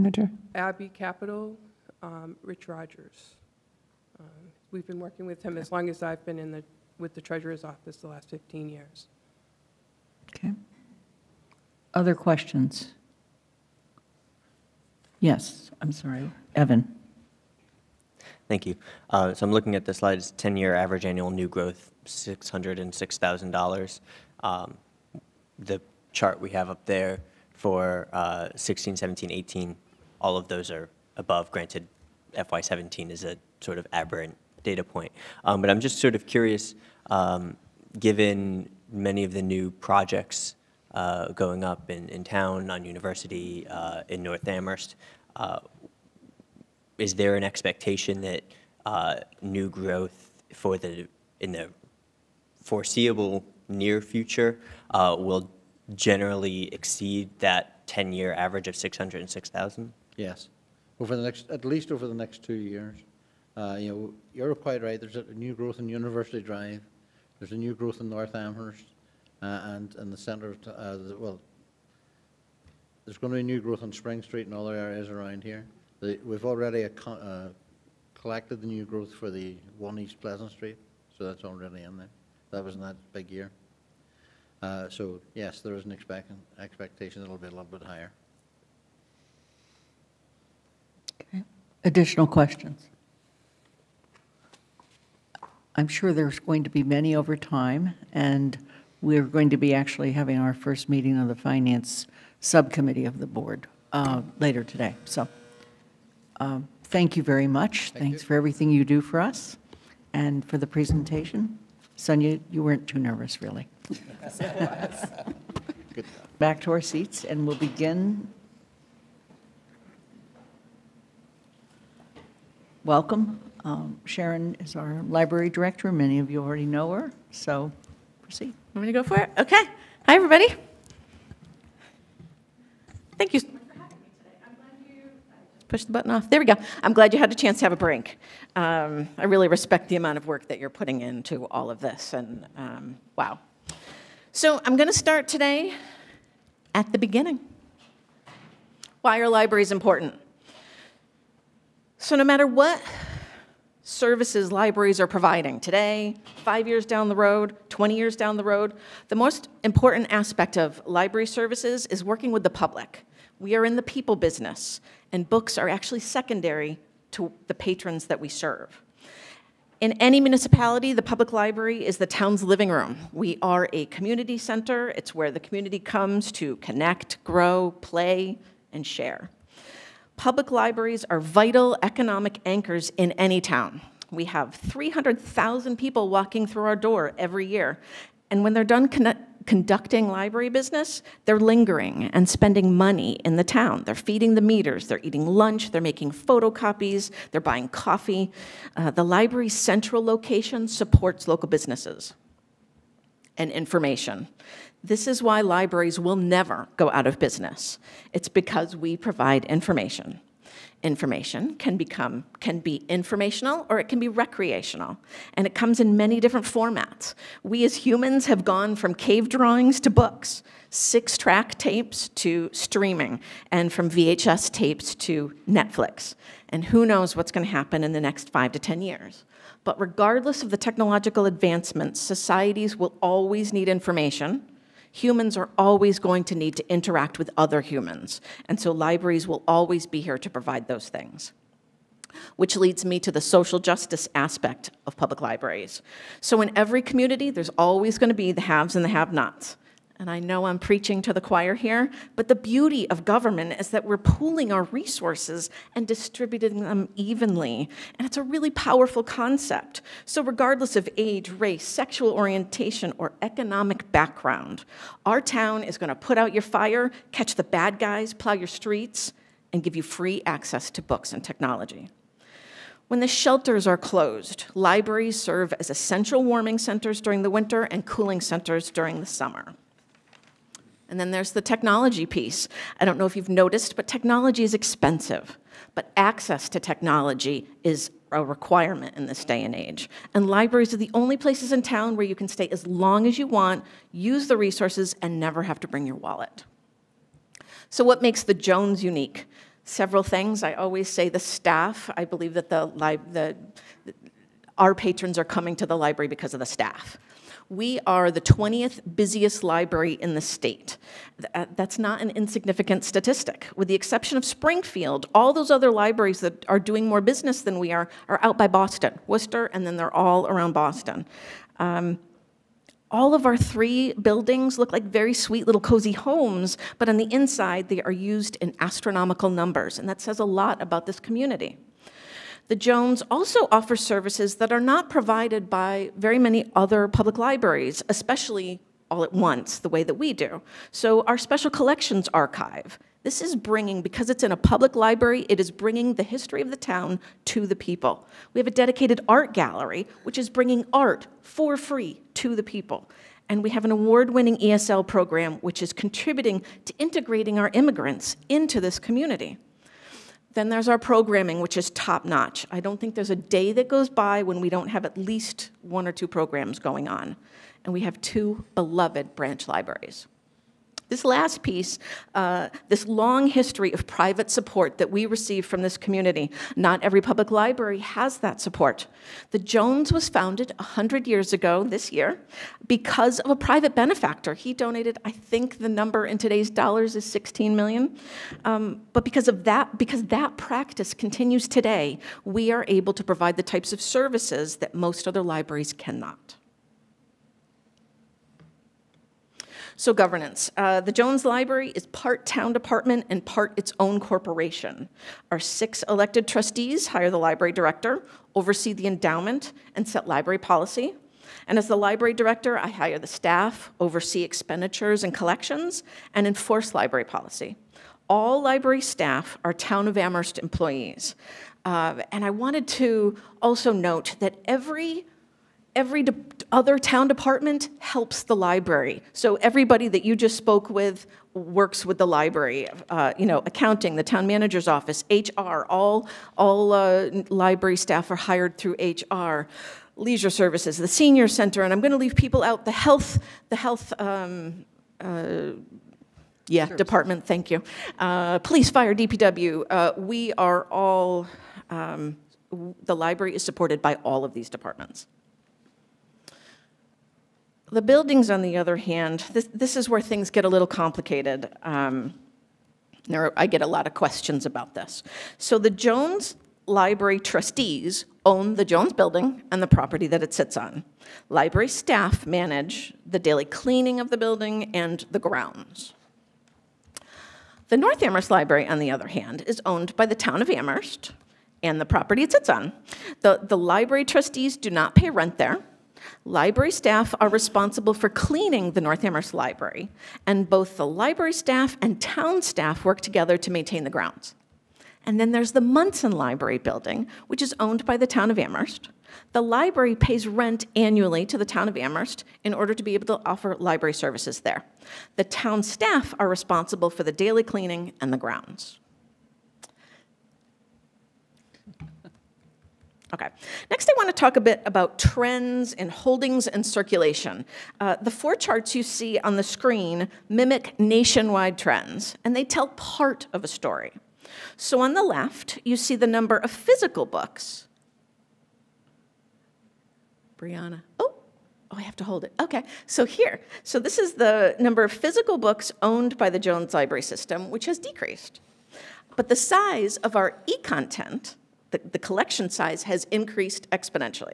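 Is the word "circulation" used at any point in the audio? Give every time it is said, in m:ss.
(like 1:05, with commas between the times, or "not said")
8:36.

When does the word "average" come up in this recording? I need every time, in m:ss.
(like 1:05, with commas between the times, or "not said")
0:20, 0:58.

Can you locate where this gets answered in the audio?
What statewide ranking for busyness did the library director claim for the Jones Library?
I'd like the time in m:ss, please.
5:08.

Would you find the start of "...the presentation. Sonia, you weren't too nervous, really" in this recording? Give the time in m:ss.
1:50.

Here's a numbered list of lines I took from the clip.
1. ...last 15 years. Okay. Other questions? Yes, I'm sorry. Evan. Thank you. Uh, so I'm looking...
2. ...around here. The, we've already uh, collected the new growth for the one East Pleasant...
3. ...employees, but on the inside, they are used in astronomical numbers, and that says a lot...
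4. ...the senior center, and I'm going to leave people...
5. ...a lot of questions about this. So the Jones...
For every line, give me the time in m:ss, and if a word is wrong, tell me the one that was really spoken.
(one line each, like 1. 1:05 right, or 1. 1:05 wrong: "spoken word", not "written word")
1. 0:08 right
2. 1:15 right
3. 5:25 wrong: "homes", not "employees"
4. 7:20 right
5. 7:43 right.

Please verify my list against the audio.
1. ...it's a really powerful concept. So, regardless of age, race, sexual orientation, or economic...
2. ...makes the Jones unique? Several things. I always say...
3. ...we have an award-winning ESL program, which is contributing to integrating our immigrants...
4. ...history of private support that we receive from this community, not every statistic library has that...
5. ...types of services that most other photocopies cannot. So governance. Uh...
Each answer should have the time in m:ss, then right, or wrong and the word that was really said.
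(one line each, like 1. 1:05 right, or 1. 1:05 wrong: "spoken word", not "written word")
1. 4:18 right
2. 4:58 right
3. 5:53 right
4. 6:13 wrong: "public", not "statistic"
5. 6:33 wrong: "libraries", not "photocopies".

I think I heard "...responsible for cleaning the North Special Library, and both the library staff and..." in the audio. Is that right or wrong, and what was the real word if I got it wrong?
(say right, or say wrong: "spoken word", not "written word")
wrong: "Amherst", not "Special".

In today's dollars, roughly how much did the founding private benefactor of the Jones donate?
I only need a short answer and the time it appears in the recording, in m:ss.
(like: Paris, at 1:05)
16 million, at 6:27.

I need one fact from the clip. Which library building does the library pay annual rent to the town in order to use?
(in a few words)
Munson Library.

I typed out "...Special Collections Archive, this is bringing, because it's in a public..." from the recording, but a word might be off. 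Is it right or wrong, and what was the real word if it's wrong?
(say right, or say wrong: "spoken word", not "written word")
right.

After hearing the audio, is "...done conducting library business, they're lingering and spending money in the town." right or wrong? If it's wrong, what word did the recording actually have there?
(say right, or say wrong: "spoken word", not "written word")
right.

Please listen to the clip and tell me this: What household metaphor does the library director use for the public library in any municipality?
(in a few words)
the town's living room.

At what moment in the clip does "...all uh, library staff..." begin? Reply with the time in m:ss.
7:16.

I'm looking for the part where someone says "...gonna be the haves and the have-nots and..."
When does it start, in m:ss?
4:07.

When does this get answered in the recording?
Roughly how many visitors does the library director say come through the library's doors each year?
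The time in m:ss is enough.
3:04.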